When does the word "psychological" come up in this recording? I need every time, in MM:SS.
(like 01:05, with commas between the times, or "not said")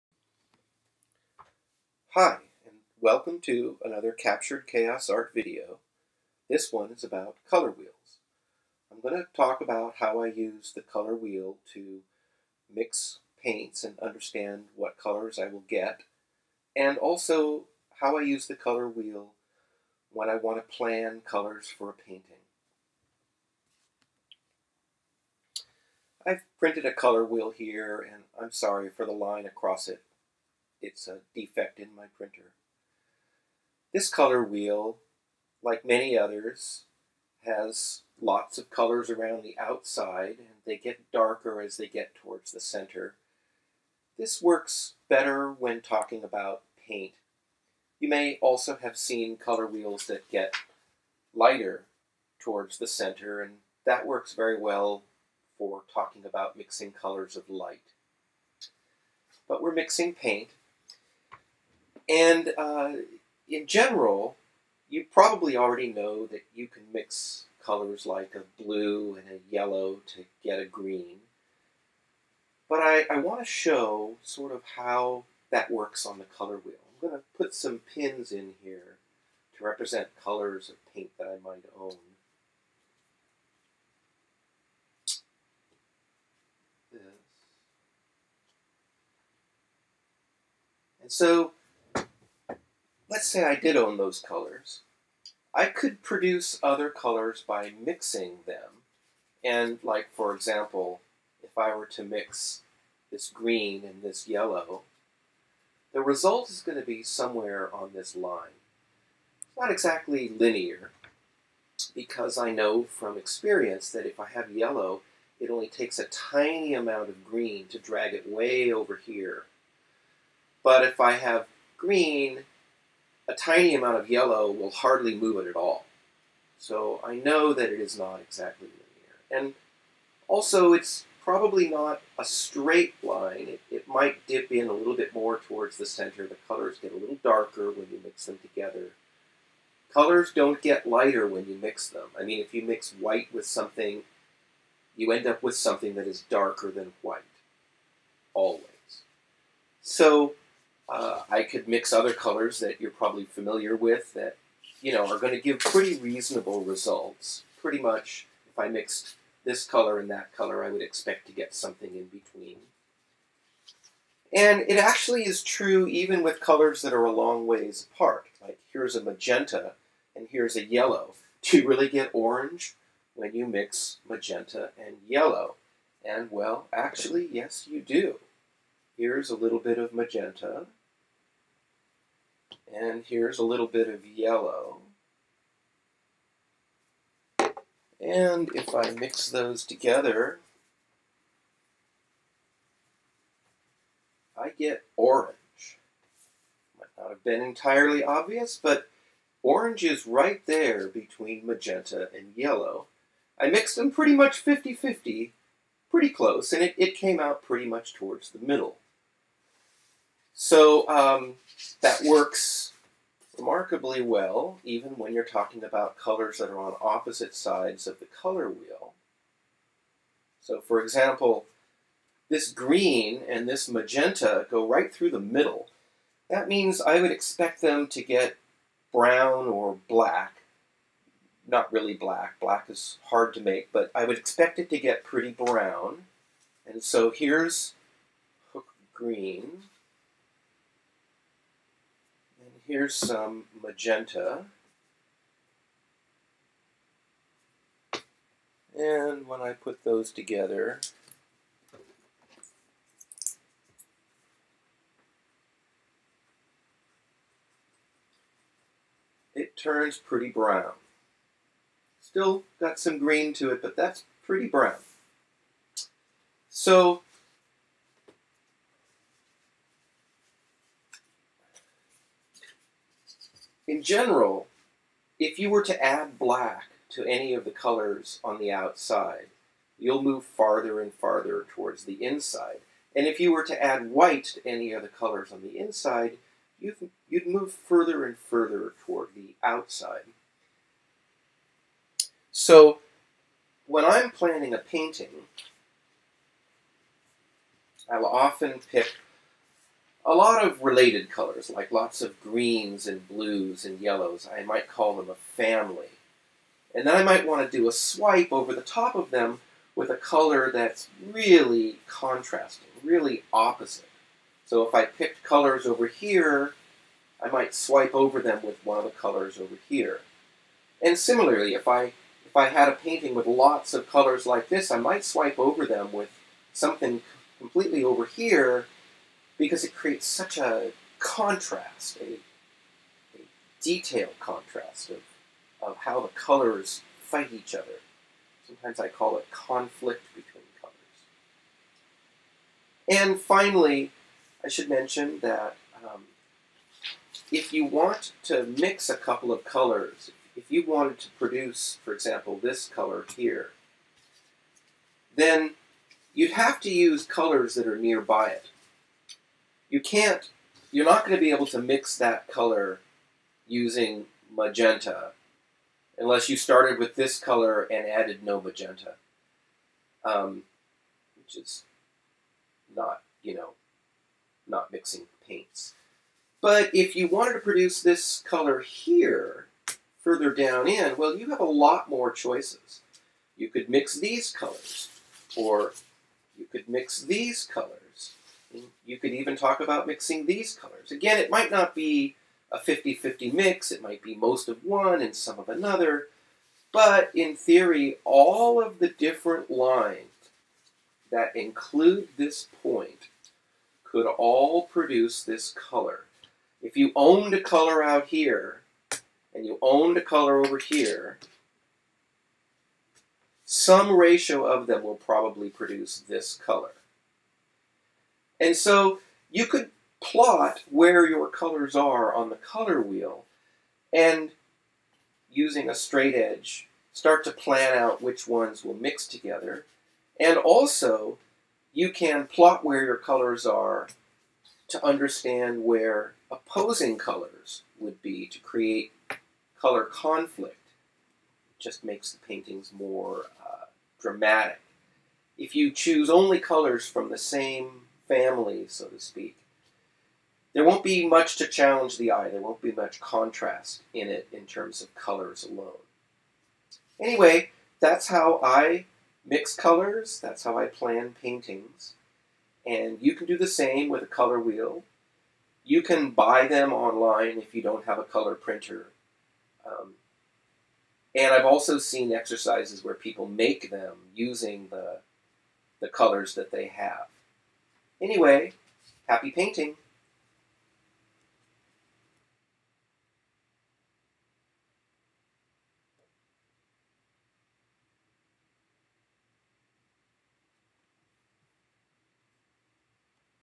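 not said.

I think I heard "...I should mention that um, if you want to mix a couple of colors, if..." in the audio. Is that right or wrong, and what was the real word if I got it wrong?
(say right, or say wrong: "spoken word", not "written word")
right.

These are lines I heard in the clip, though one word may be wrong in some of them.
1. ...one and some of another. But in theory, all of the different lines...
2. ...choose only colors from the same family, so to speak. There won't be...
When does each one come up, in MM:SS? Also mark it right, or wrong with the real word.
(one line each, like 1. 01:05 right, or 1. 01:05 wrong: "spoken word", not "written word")
1. 06:34 right
2. 07:25 right.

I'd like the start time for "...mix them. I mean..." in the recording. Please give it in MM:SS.
02:21.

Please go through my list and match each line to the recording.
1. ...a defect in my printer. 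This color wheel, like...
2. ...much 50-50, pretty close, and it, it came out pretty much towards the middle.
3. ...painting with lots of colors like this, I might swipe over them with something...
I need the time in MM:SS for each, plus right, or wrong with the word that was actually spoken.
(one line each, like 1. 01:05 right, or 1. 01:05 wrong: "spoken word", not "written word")
1. 00:31 right
2. 03:24 right
3. 05:22 right.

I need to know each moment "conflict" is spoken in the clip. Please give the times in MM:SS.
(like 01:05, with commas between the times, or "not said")
05:39, 07:19.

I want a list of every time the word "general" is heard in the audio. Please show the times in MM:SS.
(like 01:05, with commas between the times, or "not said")
01:03, 04:33.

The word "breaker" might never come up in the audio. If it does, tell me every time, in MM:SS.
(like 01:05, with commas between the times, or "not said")
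not said.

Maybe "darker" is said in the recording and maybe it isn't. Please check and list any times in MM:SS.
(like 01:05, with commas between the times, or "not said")
00:41, 02:17, 02:26.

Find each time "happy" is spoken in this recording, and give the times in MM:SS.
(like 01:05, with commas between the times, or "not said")
07:59.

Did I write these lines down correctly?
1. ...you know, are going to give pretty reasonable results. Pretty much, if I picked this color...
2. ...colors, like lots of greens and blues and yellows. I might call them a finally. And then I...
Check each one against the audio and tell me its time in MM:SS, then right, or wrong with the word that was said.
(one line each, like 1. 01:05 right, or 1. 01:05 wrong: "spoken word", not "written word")
1. 02:34 wrong: "mixed", not "picked"
2. 05:01 wrong: "family", not "finally".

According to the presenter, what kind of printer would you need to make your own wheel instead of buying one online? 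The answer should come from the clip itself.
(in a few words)
color printer.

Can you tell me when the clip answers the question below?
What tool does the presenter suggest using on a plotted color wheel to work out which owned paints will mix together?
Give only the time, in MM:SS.
07:05.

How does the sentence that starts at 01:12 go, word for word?
But I, I want to show sort of how that works on the color wheel.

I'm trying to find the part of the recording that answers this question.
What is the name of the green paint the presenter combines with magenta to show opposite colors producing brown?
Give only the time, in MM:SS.
03:58.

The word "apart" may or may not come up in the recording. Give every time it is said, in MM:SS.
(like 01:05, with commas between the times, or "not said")
02:47.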